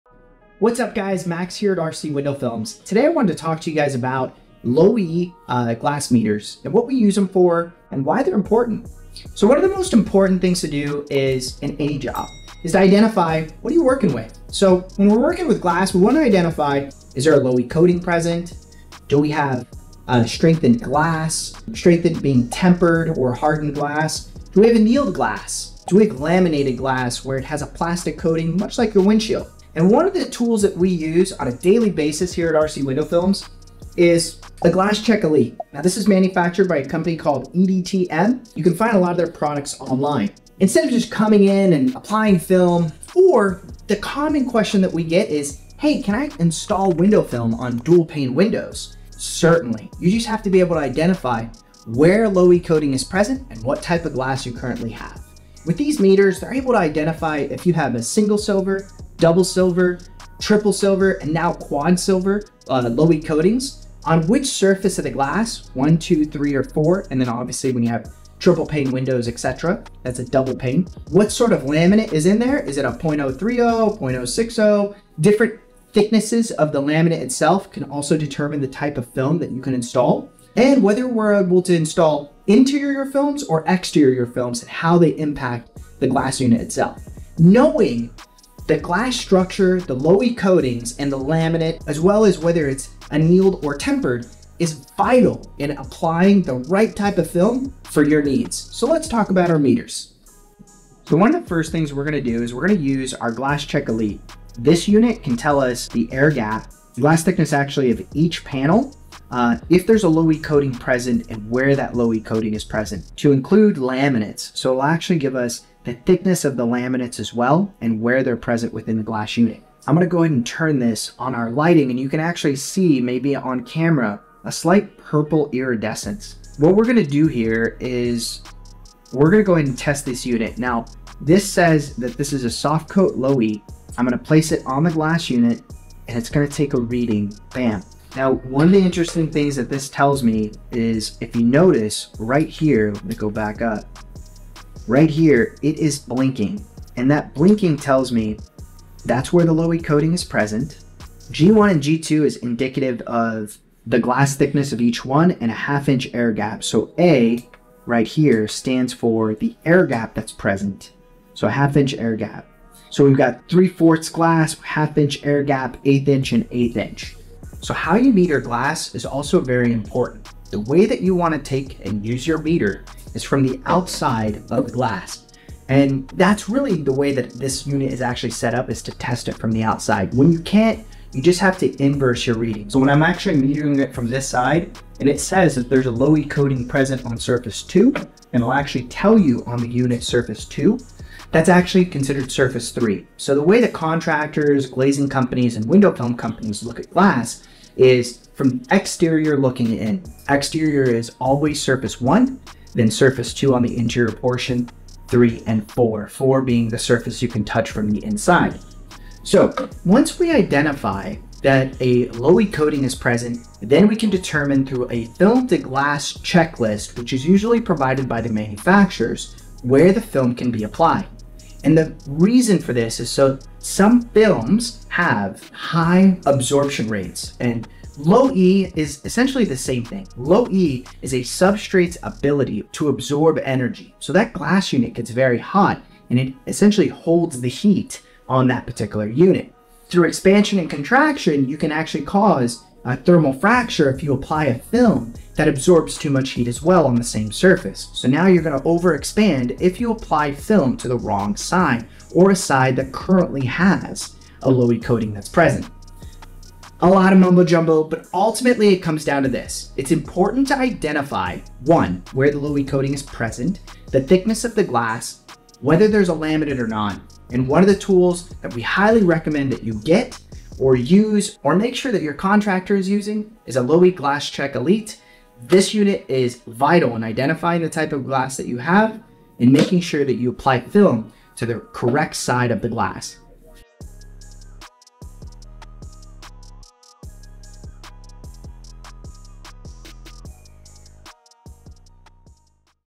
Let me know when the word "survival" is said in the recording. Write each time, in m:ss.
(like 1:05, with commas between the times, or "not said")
not said.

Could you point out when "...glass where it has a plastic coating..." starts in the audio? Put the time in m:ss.
0:26.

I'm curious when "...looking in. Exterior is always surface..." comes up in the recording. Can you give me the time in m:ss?
3:19.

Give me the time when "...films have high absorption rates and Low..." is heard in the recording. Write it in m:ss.
3:44.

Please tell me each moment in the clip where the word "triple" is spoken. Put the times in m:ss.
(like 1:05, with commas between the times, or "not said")
1:00, 1:08.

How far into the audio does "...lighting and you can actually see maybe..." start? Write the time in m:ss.
2:01.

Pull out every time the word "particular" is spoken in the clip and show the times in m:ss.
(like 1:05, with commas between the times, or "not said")
3:58.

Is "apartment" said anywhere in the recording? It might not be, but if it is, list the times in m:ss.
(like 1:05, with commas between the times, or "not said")
not said.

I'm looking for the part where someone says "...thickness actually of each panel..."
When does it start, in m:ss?
1:47.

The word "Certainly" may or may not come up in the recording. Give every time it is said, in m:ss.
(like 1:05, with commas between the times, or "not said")
0:49.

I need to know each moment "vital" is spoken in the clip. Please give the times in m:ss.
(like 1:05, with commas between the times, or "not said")
1:34, 4:36.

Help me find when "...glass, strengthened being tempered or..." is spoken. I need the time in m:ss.
0:20.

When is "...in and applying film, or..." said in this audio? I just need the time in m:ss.
0:41.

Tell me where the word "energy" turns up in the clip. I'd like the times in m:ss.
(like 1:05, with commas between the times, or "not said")
3:53.